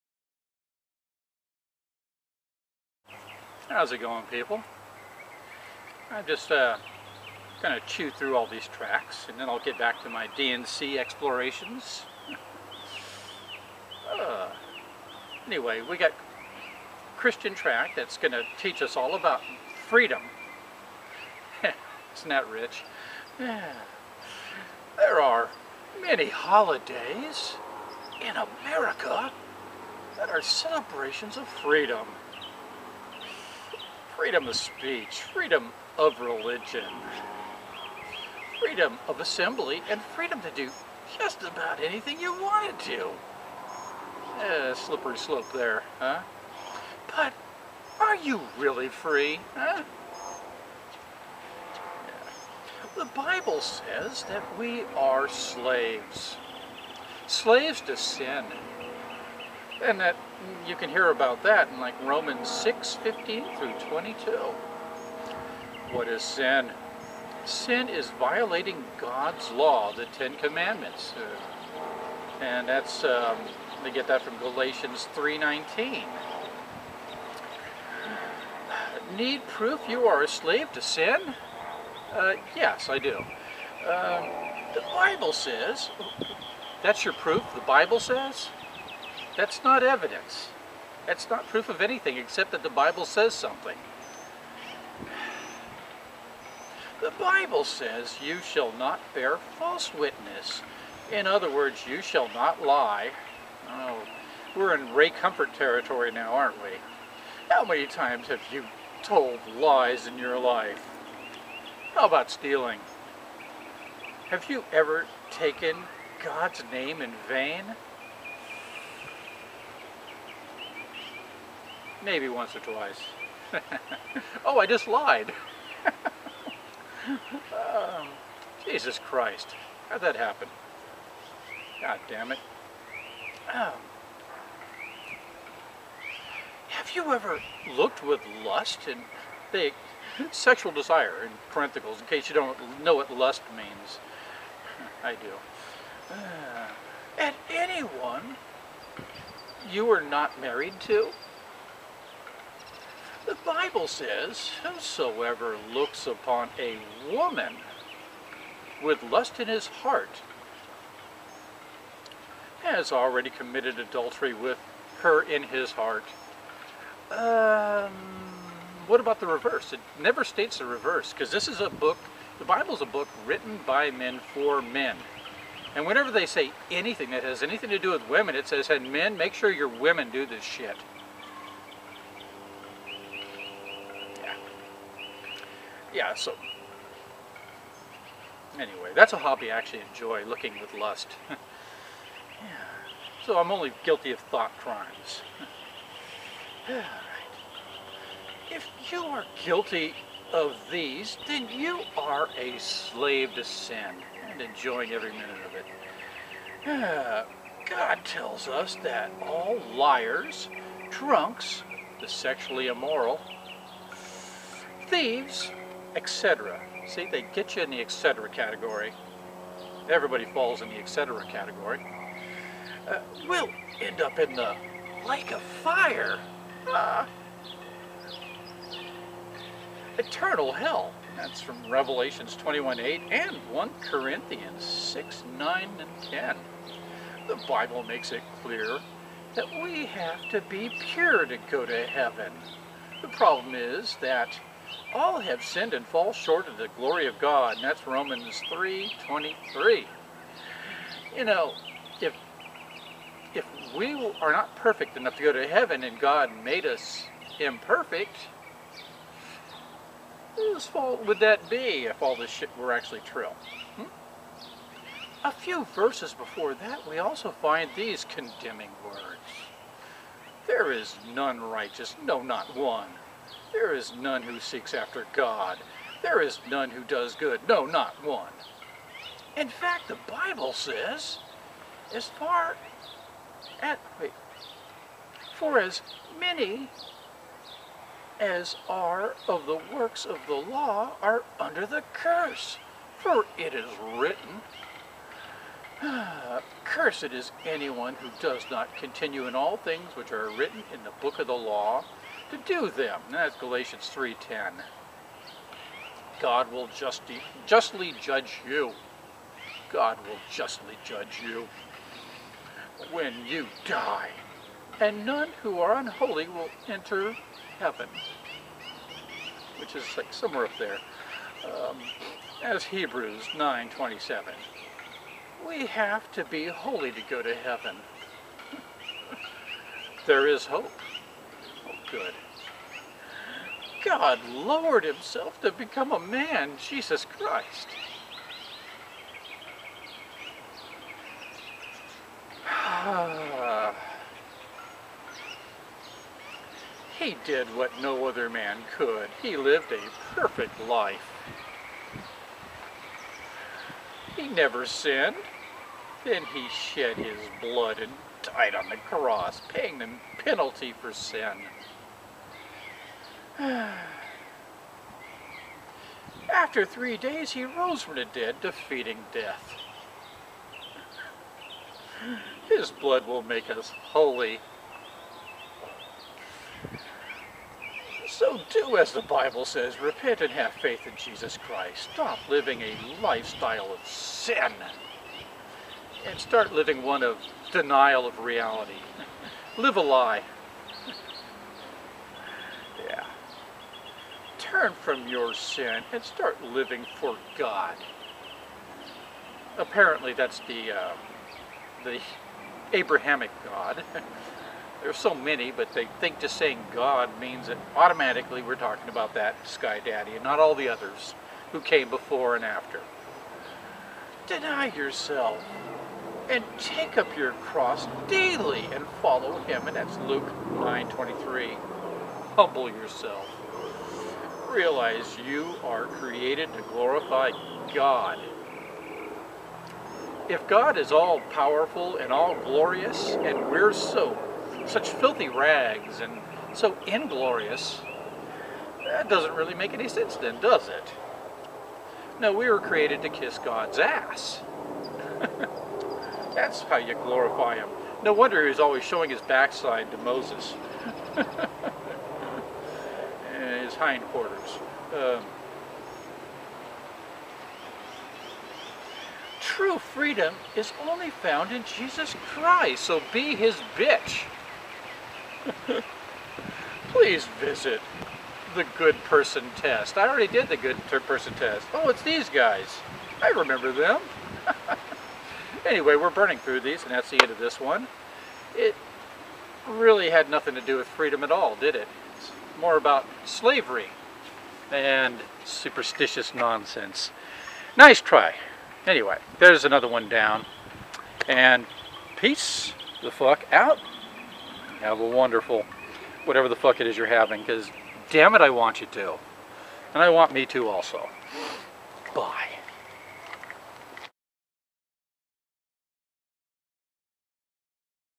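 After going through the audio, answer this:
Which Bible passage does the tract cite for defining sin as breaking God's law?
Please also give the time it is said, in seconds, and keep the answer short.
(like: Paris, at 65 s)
Galatians 3:19, at 74 s.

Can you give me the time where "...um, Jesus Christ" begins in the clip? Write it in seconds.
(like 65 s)
127 s.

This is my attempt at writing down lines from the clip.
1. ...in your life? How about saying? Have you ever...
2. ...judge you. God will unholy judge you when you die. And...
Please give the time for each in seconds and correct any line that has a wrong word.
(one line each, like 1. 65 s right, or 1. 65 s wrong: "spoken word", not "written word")
1. 110 s wrong: "stealing", not "saying"
2. 308 s wrong: "justly", not "unholy".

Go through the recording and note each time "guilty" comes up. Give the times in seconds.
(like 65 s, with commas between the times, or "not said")
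193 s, 199 s.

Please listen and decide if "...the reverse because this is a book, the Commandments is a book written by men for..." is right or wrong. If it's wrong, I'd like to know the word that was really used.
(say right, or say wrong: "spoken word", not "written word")
wrong: "Bible", not "Commandments".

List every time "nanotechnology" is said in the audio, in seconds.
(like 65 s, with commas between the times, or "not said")
not said.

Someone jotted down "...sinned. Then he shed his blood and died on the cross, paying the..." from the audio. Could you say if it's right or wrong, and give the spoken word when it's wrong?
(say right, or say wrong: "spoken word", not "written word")
right.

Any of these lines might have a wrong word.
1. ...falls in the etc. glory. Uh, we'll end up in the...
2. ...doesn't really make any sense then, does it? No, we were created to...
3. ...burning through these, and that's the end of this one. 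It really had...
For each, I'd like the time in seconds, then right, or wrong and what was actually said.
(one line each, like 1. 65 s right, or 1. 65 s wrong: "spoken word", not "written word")
1. 220 s wrong: "category", not "glory"
2. 439 s right
3. 476 s right.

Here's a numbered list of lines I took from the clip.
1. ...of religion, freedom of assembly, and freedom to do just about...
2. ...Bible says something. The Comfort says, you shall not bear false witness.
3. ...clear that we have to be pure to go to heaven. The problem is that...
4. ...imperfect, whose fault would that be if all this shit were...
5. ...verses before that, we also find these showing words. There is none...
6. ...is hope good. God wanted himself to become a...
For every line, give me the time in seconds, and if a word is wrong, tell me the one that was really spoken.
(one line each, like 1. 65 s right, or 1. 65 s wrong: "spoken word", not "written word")
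1. 35 s right
2. 92 s wrong: "Bible", not "Comfort"
3. 238 s right
4. 257 s right
5. 265 s wrong: "condemning", not "showing"
6. 330 s wrong: "lowered", not "wanted".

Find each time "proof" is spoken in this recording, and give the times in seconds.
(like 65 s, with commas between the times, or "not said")
79 s, 87 s, 91 s.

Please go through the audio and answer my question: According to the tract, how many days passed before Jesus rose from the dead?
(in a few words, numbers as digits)
3.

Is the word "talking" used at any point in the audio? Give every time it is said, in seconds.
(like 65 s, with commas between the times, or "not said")
408 s.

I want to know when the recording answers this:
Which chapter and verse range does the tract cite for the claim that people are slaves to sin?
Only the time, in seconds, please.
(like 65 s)
62 s.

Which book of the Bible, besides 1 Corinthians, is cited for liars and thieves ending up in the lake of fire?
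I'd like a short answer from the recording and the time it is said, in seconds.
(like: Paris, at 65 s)
Revelations, at 231 s.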